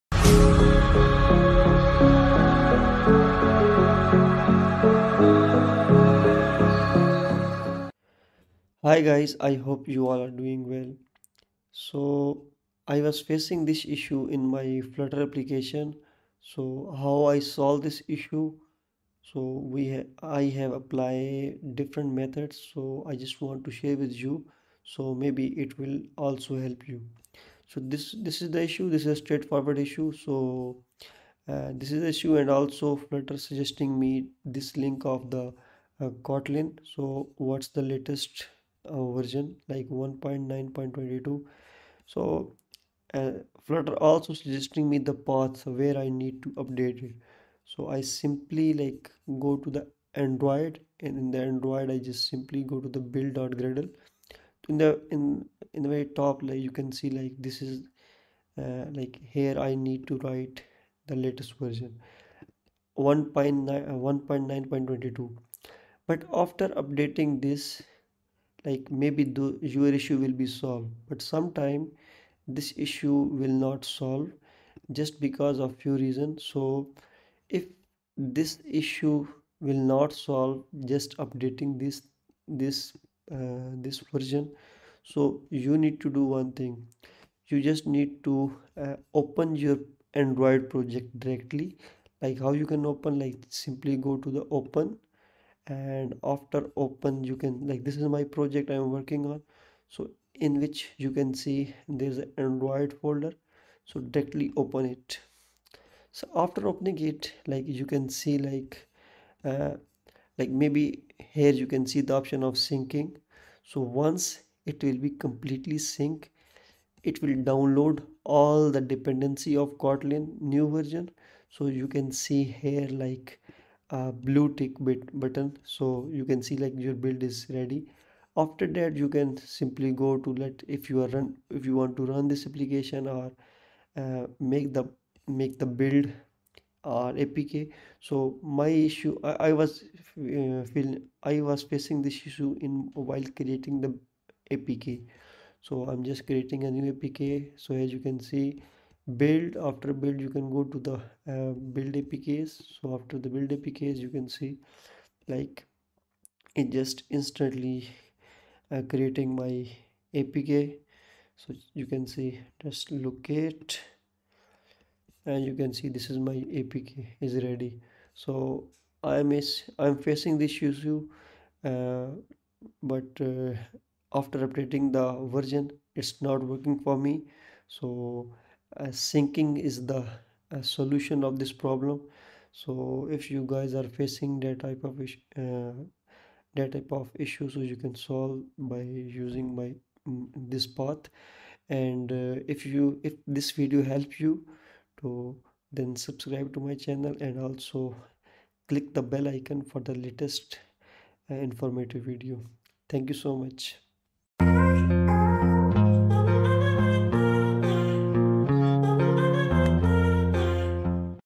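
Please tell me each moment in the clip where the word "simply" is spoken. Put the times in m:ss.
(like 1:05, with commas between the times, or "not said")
0:48, 0:52, 1:33, 2:09.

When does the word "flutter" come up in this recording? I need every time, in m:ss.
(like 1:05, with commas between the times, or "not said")
0:14, 0:32, 0:43.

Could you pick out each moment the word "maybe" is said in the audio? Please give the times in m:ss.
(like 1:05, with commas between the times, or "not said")
0:25, 1:09, 1:50.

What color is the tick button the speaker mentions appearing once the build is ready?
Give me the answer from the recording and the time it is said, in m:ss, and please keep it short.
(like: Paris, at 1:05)
blue, at 2:04.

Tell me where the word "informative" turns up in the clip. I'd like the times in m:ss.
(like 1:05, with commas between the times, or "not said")
3:21.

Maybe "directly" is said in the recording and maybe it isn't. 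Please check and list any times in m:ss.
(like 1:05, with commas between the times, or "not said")
1:31, 1:44.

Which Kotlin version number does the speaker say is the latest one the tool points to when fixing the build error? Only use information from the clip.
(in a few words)
1.9.22.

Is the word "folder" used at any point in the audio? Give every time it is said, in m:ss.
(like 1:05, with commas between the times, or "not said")
1:43.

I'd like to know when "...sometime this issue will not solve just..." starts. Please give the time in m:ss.
1:11.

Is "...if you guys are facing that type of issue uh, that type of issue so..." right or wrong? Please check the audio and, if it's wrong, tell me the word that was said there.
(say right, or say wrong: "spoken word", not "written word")
right.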